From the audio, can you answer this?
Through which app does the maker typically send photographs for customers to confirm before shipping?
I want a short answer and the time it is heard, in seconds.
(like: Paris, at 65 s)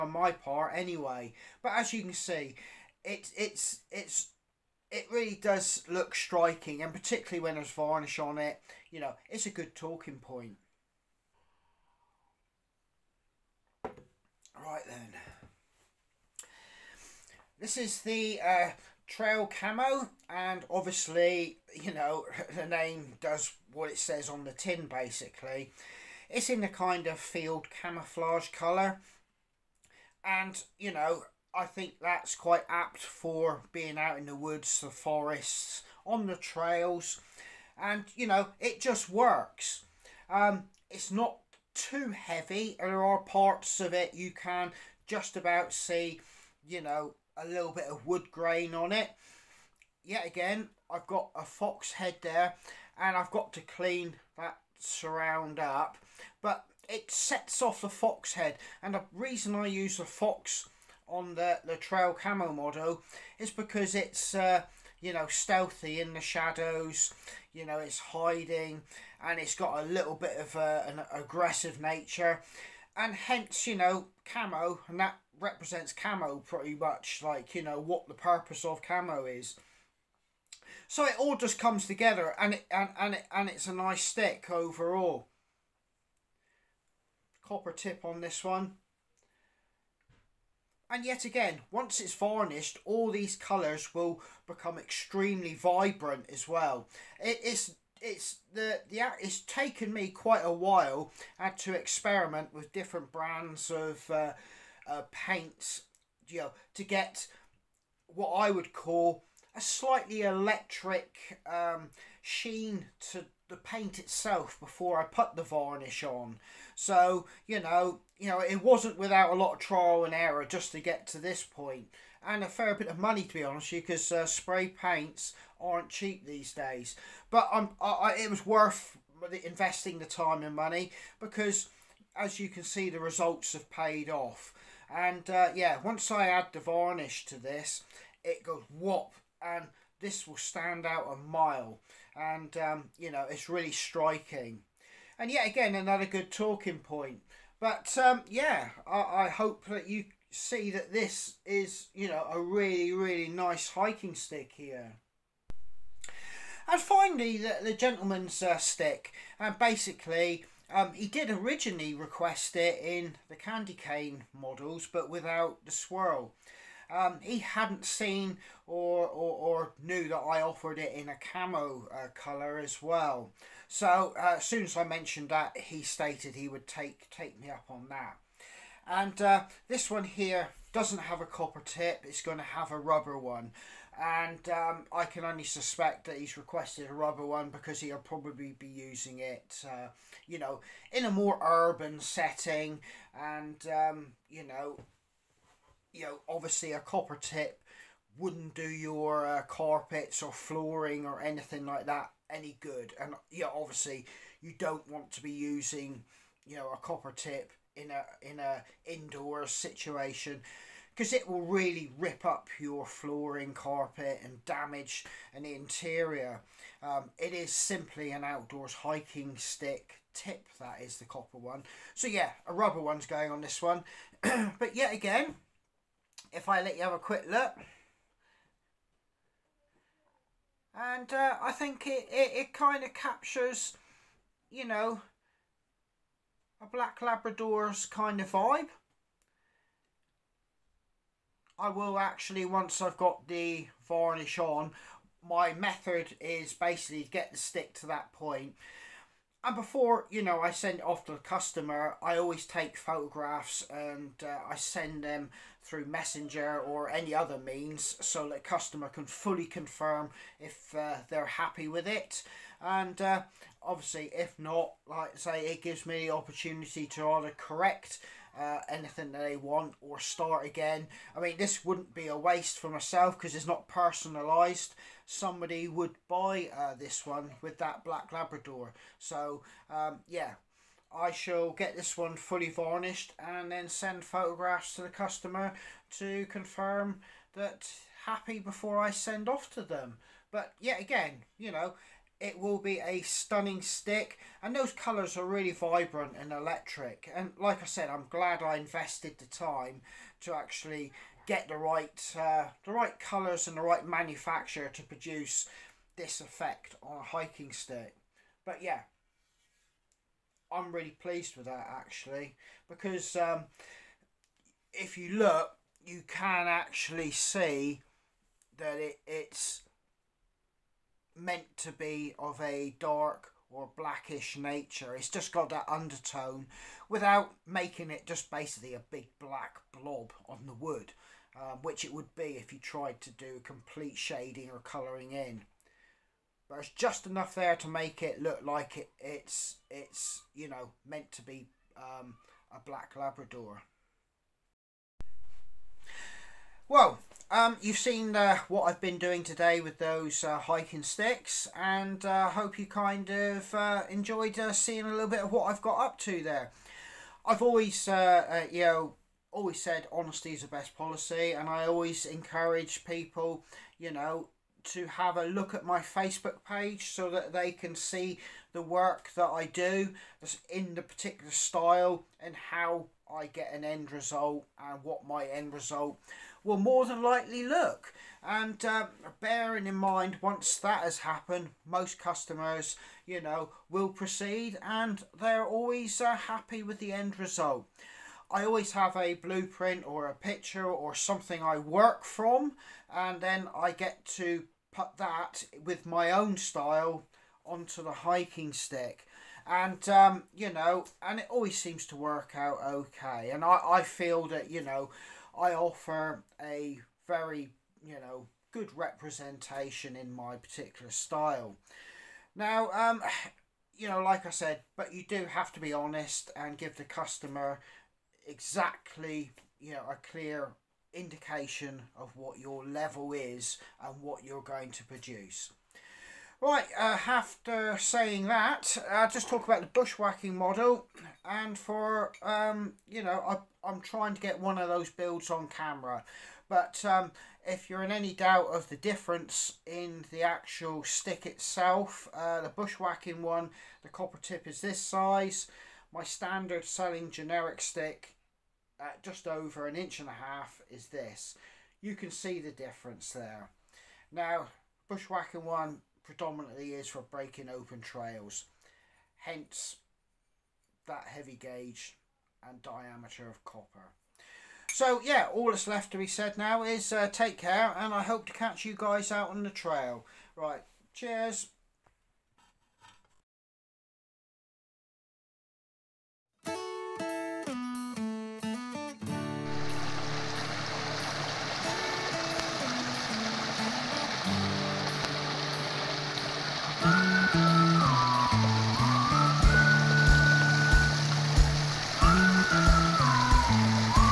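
Messenger, at 255 s.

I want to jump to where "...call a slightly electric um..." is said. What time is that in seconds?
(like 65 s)
108 s.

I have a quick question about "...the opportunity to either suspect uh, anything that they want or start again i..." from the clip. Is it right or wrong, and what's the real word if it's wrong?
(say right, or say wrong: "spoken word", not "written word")
wrong: "correct", not "suspect".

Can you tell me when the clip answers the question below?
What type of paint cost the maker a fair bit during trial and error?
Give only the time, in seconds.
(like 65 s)
124 s.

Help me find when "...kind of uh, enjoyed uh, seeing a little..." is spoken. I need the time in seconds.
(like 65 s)
352 s.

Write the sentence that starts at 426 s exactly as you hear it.
Right, uh, after saying that, I'll just talk about the bushwhacking model.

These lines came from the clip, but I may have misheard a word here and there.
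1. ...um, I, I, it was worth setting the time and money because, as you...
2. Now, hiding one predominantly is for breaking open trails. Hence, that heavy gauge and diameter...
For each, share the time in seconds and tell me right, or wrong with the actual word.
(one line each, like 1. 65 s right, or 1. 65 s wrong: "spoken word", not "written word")
1. 127 s wrong: "investing", not "setting"
2. 454 s wrong: "bushwhacking", not "hiding".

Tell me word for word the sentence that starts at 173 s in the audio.
So uh, as soon as I mentioned that, he stated he would take, take me up on that.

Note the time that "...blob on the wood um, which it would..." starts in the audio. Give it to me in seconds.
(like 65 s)
329 s.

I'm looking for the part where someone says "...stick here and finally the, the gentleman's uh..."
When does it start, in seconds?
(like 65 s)
154 s.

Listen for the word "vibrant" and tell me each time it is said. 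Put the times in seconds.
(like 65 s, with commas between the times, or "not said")
95 s, 295 s.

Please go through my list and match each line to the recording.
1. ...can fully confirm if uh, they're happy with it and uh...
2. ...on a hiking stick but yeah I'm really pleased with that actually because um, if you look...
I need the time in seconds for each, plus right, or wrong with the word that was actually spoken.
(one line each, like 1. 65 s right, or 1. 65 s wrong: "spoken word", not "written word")
1. 258 s right
2. 306 s right.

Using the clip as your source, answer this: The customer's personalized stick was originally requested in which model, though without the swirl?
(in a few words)
Candy cane.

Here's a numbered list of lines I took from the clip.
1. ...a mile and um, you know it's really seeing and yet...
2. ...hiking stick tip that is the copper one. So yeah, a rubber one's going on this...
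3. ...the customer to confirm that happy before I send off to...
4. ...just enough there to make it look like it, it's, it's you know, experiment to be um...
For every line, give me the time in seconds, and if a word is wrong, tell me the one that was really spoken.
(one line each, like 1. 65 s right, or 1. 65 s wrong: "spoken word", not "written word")
1. 141 s wrong: "striking", not "seeing"
2. 218 s right
3. 284 s right
4. 336 s wrong: "meant", not "experiment".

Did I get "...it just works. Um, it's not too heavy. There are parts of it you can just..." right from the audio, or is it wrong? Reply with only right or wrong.
right.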